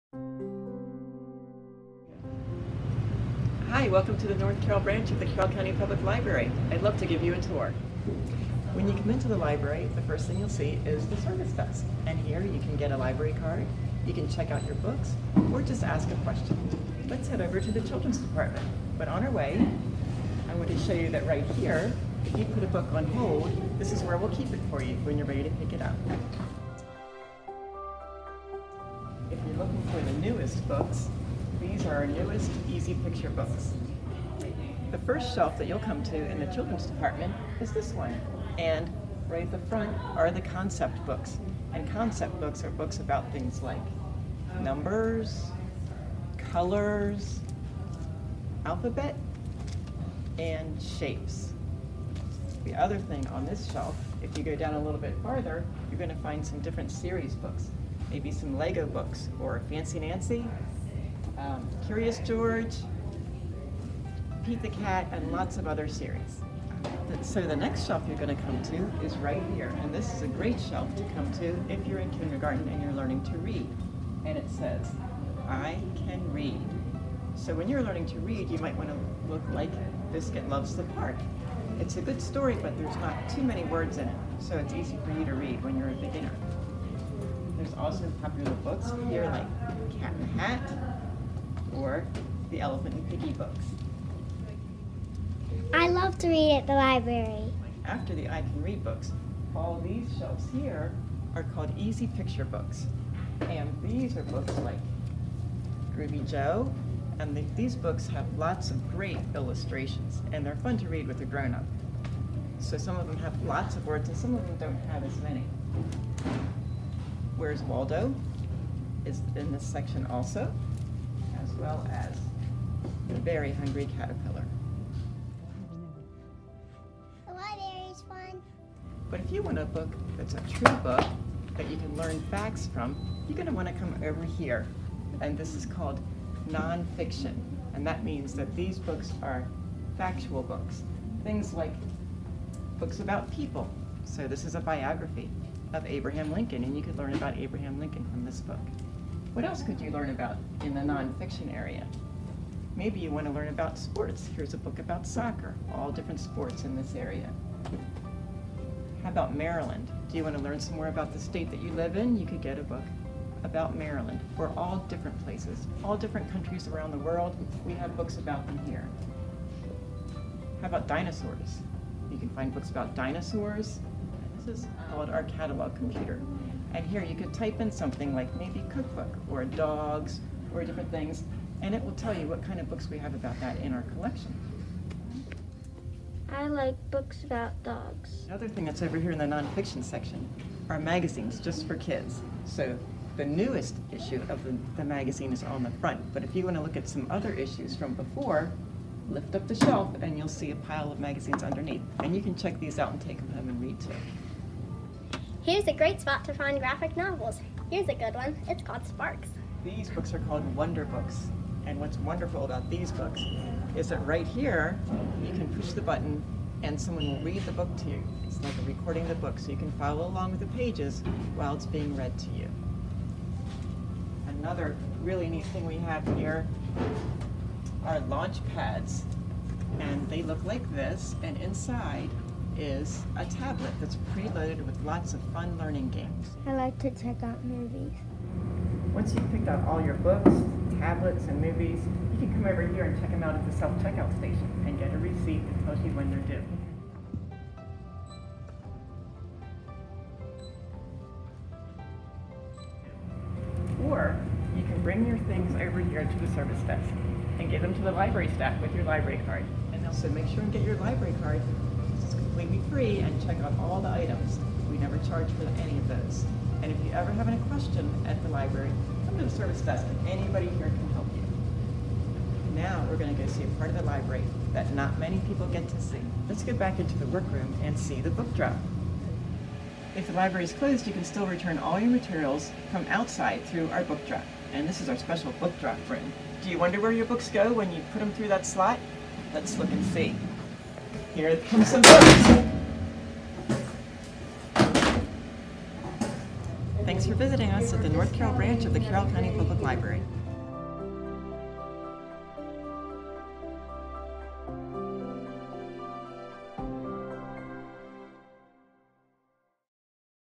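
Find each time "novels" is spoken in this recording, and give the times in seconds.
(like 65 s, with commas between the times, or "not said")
206 s.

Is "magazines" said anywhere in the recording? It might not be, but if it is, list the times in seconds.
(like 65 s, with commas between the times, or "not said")
190 s, 194 s, 200 s.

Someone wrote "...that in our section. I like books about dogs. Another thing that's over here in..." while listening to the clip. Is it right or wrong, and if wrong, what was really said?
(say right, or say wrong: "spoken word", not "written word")
wrong: "collection", not "section".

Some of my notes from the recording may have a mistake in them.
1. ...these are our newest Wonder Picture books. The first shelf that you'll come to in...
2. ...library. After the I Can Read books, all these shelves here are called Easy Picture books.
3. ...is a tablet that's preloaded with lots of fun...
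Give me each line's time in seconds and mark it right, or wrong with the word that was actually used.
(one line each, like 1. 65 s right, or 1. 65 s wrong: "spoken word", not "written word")
1. 31 s wrong: "Easy", not "Wonder"
2. 96 s right
3. 232 s right.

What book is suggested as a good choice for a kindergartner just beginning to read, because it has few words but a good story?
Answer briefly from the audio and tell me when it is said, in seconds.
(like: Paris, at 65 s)
Biscuit Loves the Park, at 80 s.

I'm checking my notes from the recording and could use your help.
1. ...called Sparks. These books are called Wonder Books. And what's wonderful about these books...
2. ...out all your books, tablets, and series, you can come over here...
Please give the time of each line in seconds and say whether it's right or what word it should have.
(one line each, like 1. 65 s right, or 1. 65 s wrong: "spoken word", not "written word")
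1. 208 s right
2. 239 s wrong: "movies", not "series".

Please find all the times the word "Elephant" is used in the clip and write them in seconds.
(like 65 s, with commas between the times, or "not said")
92 s.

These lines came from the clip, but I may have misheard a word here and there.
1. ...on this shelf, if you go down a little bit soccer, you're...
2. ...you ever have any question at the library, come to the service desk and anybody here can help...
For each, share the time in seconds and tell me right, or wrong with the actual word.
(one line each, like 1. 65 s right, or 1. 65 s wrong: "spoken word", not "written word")
1. 53 s wrong: "farther", not "soccer"
2. 266 s right.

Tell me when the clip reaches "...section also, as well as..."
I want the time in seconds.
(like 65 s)
119 s.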